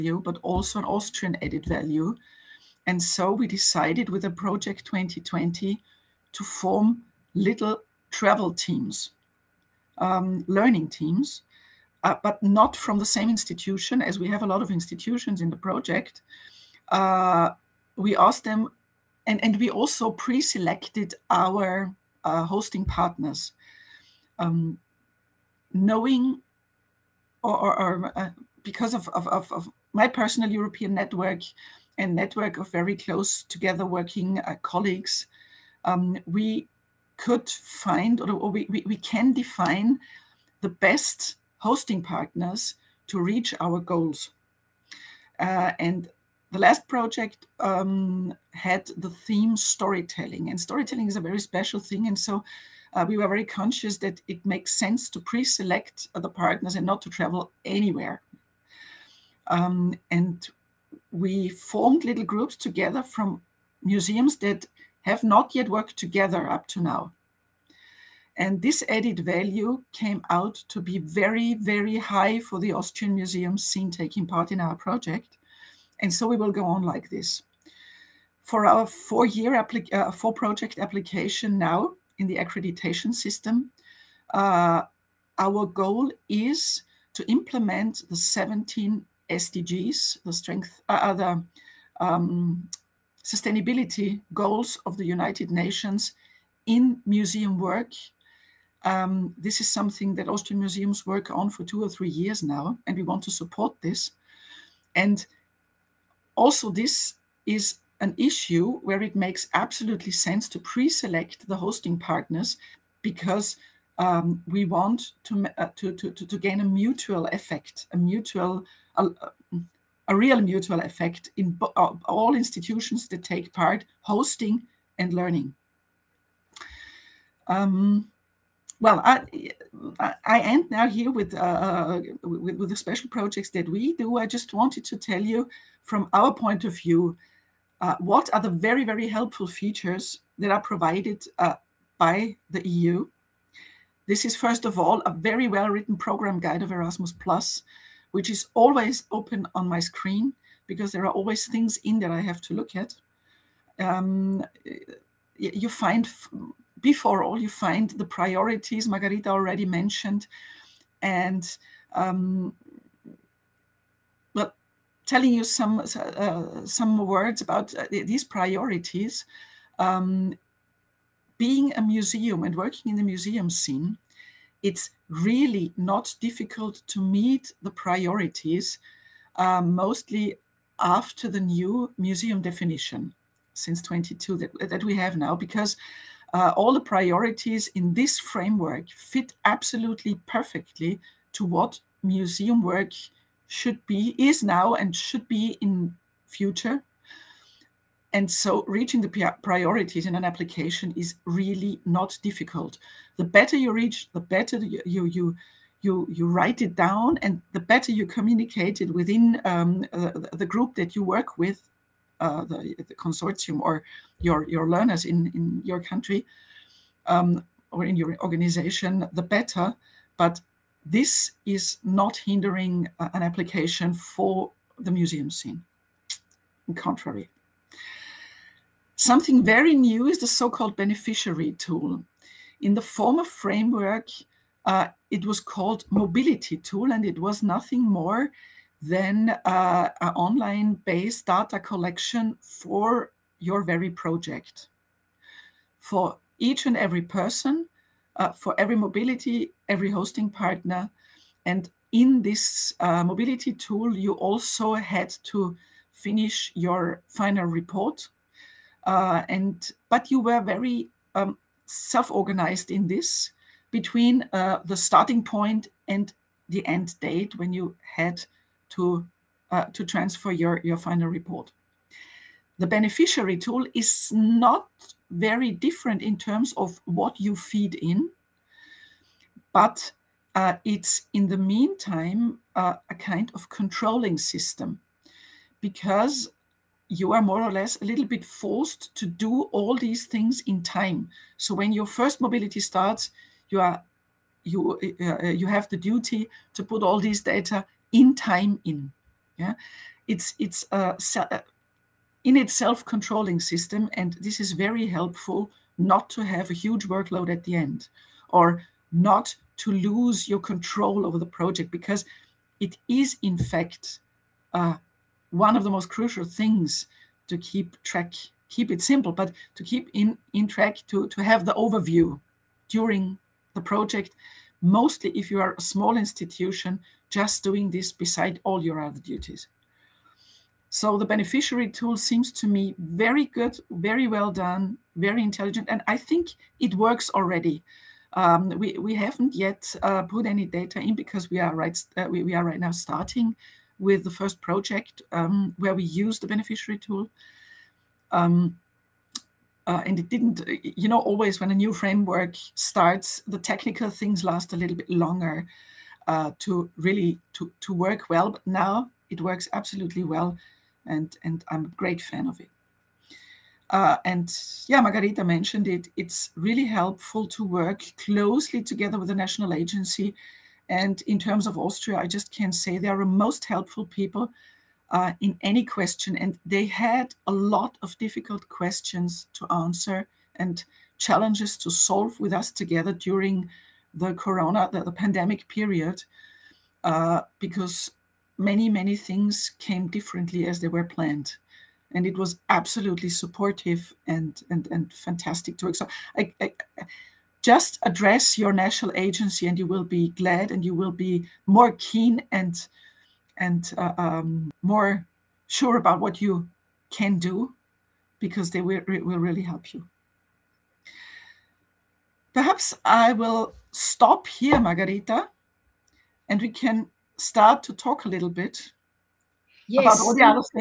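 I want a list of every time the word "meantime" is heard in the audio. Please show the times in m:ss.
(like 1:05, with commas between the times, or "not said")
4:41.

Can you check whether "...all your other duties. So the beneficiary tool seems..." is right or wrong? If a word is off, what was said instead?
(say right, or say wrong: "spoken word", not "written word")
right.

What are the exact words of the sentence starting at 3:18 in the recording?
And so reaching the priorities in an application is really not difficult.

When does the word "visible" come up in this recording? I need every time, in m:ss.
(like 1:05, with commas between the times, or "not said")
not said.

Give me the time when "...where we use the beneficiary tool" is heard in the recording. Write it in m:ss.
5:45.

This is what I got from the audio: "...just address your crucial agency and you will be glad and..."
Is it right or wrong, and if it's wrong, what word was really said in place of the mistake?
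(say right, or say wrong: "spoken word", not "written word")
wrong: "national", not "crucial".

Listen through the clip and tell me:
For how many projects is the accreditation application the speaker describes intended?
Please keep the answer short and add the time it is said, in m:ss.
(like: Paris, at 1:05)
4, at 1:20.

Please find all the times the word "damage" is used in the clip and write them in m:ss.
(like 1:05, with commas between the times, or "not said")
not said.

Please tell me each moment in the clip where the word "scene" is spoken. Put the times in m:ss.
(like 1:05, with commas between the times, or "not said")
1:13, 2:53, 3:45.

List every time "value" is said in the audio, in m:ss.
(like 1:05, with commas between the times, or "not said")
0:01, 1:09.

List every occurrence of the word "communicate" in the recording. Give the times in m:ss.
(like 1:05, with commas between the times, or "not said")
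3:28.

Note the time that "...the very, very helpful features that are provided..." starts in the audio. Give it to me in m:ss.
2:18.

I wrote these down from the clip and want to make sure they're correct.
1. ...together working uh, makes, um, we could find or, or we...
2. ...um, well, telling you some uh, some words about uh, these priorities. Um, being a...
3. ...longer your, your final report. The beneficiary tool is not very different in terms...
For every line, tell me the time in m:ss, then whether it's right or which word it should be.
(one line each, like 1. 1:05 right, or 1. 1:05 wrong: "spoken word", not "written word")
1. 0:33 wrong: "colleagues", not "makes"
2. 2:41 right
3. 4:29 wrong: "transfer", not "longer".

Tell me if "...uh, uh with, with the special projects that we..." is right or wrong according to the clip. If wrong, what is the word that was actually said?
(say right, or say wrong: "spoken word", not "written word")
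right.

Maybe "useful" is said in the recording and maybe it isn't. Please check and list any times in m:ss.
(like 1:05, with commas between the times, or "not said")
not said.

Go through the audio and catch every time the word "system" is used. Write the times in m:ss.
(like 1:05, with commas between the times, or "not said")
1:23, 4:44, 5:03.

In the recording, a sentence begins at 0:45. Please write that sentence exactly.
Uh, and the last project um, had the theme storytelling, and storytelling is a very special thing.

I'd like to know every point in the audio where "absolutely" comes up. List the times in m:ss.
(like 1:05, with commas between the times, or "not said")
1:49, 3:09, 5:59, 6:32.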